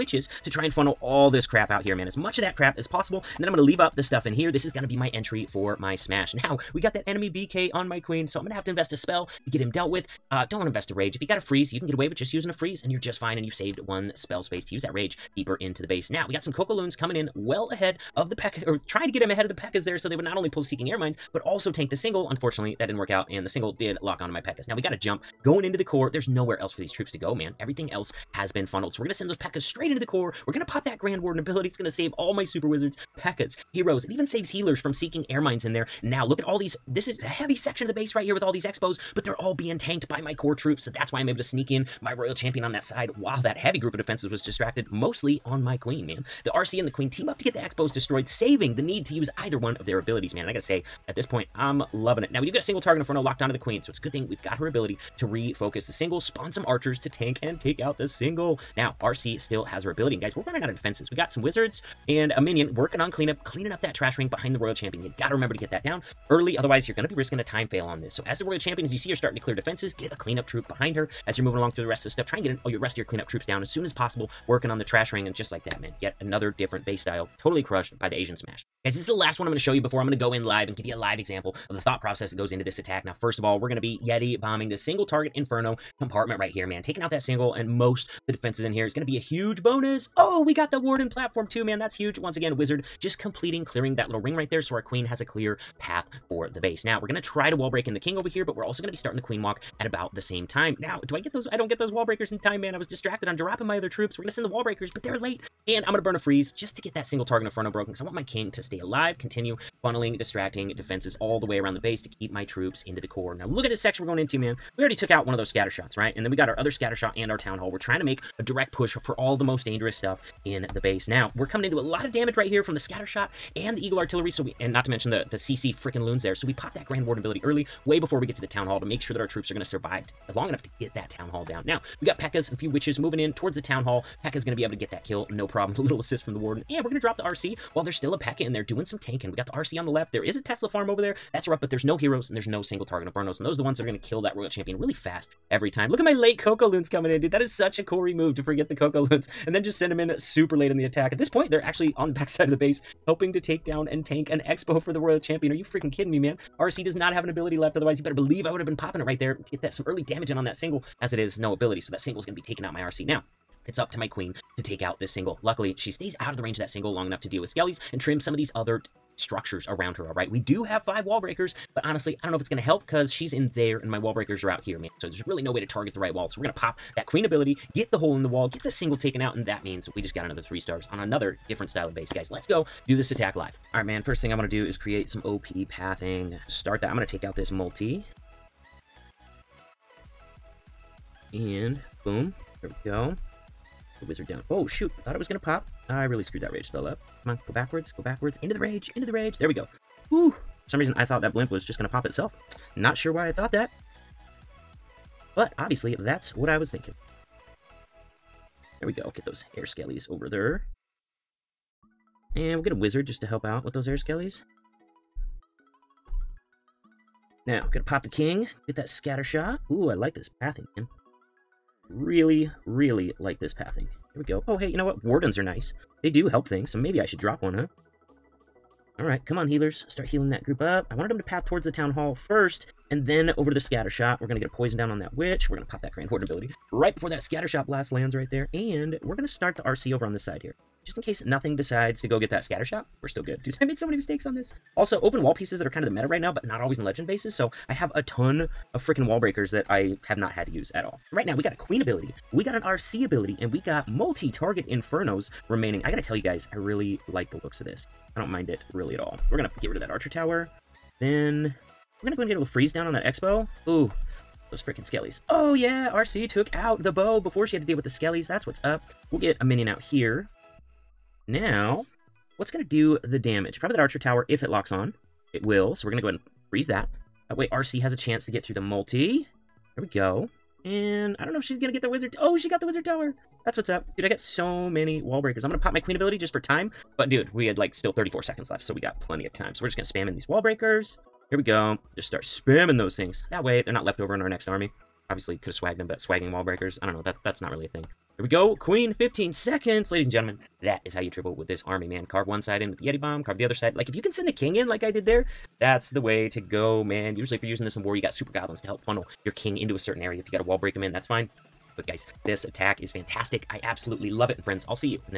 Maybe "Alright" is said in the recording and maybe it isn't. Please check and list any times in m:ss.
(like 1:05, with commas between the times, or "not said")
3:03, 3:48.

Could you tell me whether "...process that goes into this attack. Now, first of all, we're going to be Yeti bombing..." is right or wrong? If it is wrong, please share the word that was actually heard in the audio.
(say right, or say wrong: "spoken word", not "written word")
right.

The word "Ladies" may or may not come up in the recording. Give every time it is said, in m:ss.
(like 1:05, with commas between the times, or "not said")
4:59.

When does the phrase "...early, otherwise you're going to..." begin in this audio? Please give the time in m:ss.
1:06.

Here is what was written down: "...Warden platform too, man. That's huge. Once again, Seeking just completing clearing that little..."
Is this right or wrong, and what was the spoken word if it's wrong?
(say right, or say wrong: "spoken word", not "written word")
wrong: "Wizard", not "Seeking".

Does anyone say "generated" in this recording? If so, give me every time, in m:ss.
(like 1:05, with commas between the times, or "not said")
not said.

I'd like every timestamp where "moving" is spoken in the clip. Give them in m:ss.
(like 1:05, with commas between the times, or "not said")
1:11, 2:12.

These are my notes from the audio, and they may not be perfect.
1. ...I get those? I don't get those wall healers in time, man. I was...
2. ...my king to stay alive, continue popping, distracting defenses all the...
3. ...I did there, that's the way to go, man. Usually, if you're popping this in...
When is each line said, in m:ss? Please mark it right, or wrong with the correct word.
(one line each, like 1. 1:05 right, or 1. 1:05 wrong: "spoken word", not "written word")
1. 1:41 wrong: "breakers", not "healers"
2. 1:48 wrong: "funneling", not "popping"
3. 5:04 wrong: "using", not "popping".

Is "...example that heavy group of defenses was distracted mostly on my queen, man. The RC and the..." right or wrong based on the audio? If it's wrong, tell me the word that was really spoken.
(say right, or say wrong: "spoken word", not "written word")
wrong: "while", not "example".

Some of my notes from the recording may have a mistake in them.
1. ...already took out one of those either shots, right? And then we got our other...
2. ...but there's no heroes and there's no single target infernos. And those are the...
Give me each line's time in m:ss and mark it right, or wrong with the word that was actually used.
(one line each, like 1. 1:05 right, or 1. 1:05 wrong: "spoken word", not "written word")
1. 1:54 wrong: "scatter", not "either"
2. 2:21 right.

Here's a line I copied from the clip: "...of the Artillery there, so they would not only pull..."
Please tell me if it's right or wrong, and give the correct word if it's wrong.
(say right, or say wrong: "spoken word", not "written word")
wrong: "Pekkas", not "Artillery".